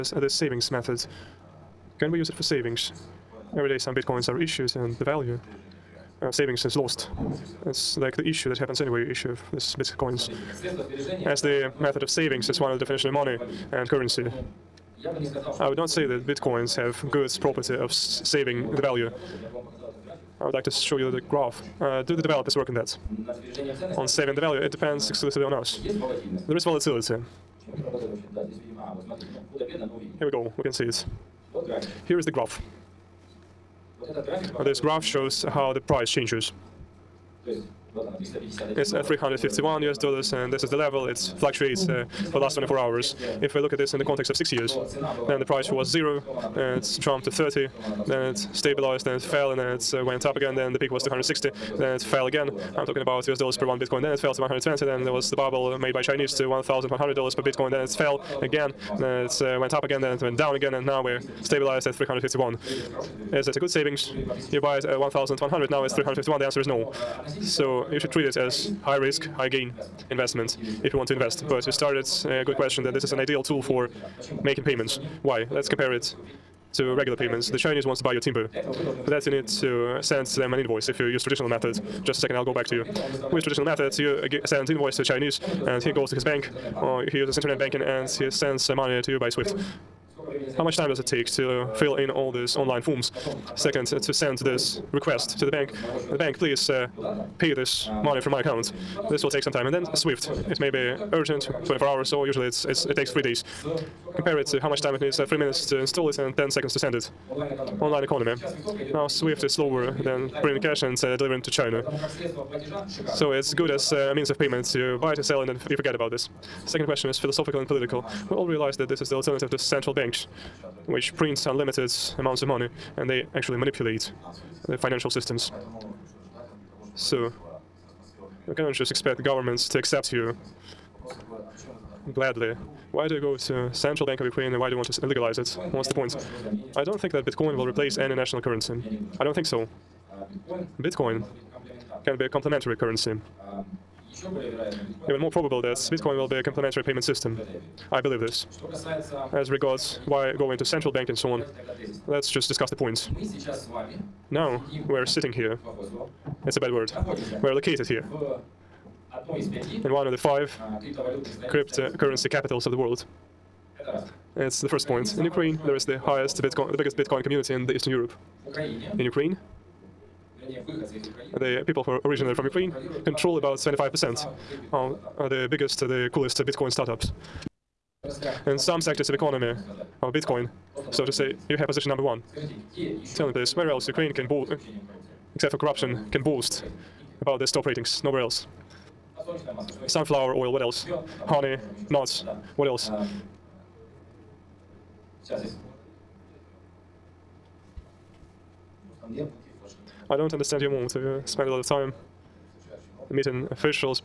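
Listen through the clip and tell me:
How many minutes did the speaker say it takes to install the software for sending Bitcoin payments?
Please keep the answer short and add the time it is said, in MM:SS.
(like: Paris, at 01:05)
3 minutes, at 01:45.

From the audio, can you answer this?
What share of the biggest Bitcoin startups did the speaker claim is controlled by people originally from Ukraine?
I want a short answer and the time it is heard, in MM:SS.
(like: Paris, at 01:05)
25%, at 02:53.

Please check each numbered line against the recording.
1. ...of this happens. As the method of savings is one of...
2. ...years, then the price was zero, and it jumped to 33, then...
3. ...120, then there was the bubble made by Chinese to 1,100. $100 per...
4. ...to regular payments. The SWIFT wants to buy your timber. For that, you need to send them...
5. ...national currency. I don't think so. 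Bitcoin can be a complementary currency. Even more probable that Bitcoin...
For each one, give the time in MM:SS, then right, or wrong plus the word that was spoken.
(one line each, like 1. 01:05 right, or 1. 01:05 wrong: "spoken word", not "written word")
1. 00:09 wrong: "bitcoins", not "happens"
2. 00:44 wrong: "30", not "33"
3. 00:54 right
4. 01:16 wrong: "Chinese", not "SWIFT"
5. 02:18 right.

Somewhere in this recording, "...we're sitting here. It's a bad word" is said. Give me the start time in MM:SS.
02:34.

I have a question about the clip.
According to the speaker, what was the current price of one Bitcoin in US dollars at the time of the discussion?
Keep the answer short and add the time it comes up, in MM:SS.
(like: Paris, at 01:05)
$351, at 00:39.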